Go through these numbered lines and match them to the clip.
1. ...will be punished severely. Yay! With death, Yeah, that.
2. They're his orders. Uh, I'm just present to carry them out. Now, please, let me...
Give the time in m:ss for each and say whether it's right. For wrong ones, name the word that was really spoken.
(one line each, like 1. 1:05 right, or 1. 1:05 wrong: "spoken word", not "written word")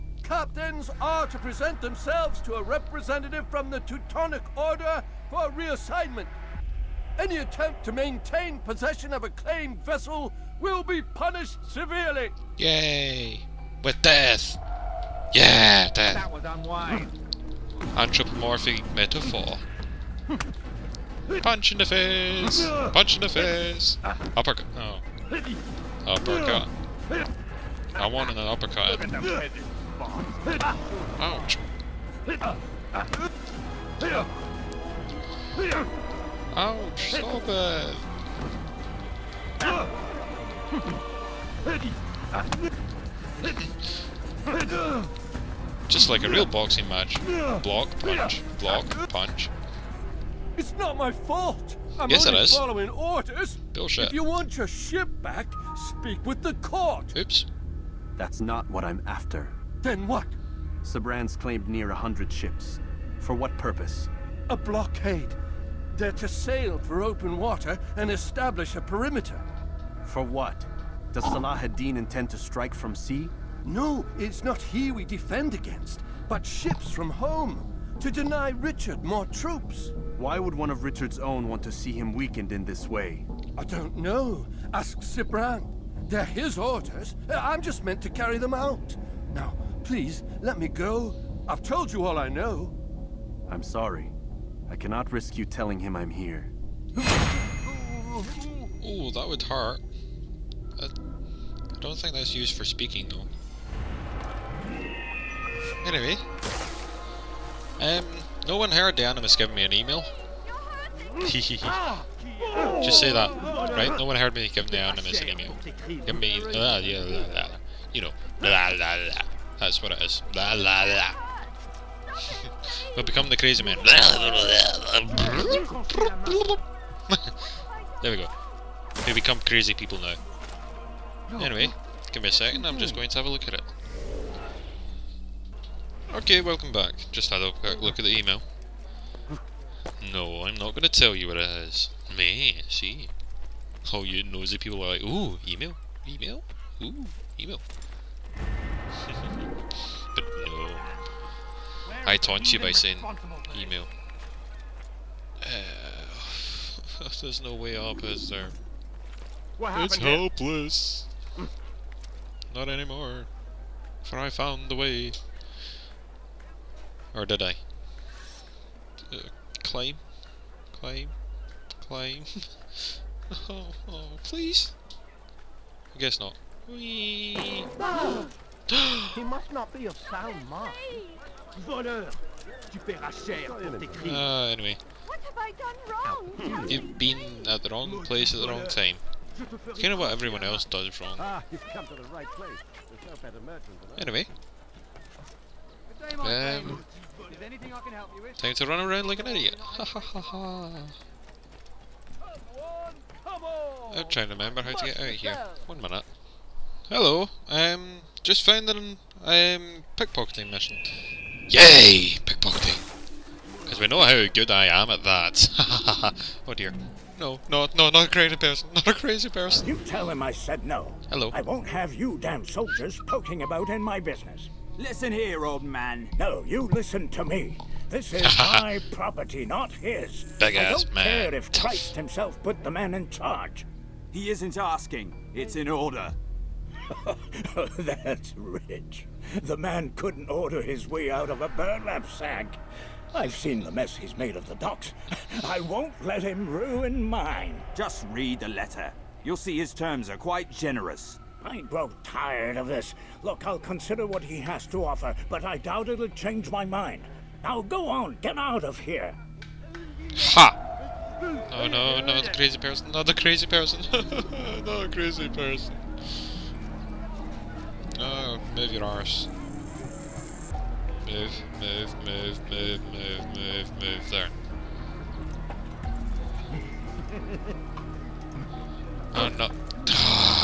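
1. 0:10 right
2. 1:26 wrong: "meant", not "present".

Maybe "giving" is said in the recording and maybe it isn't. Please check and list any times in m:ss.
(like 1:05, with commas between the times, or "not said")
1:49, 1:54.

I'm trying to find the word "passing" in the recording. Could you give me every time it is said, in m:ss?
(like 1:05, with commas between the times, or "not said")
not said.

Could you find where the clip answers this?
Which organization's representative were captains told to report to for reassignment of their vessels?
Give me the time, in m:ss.
0:03.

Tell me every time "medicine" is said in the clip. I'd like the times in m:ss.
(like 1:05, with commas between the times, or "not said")
not said.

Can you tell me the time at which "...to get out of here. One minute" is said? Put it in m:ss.
3:24.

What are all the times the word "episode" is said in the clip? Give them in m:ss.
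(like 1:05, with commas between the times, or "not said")
not said.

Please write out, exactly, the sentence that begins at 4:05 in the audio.
I won't let him ruin mine.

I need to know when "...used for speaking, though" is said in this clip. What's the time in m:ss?
1:42.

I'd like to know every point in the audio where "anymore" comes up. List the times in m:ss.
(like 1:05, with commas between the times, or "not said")
2:42.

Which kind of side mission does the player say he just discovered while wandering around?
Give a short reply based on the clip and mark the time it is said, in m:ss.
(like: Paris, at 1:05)
Pickpocketing mission, at 3:29.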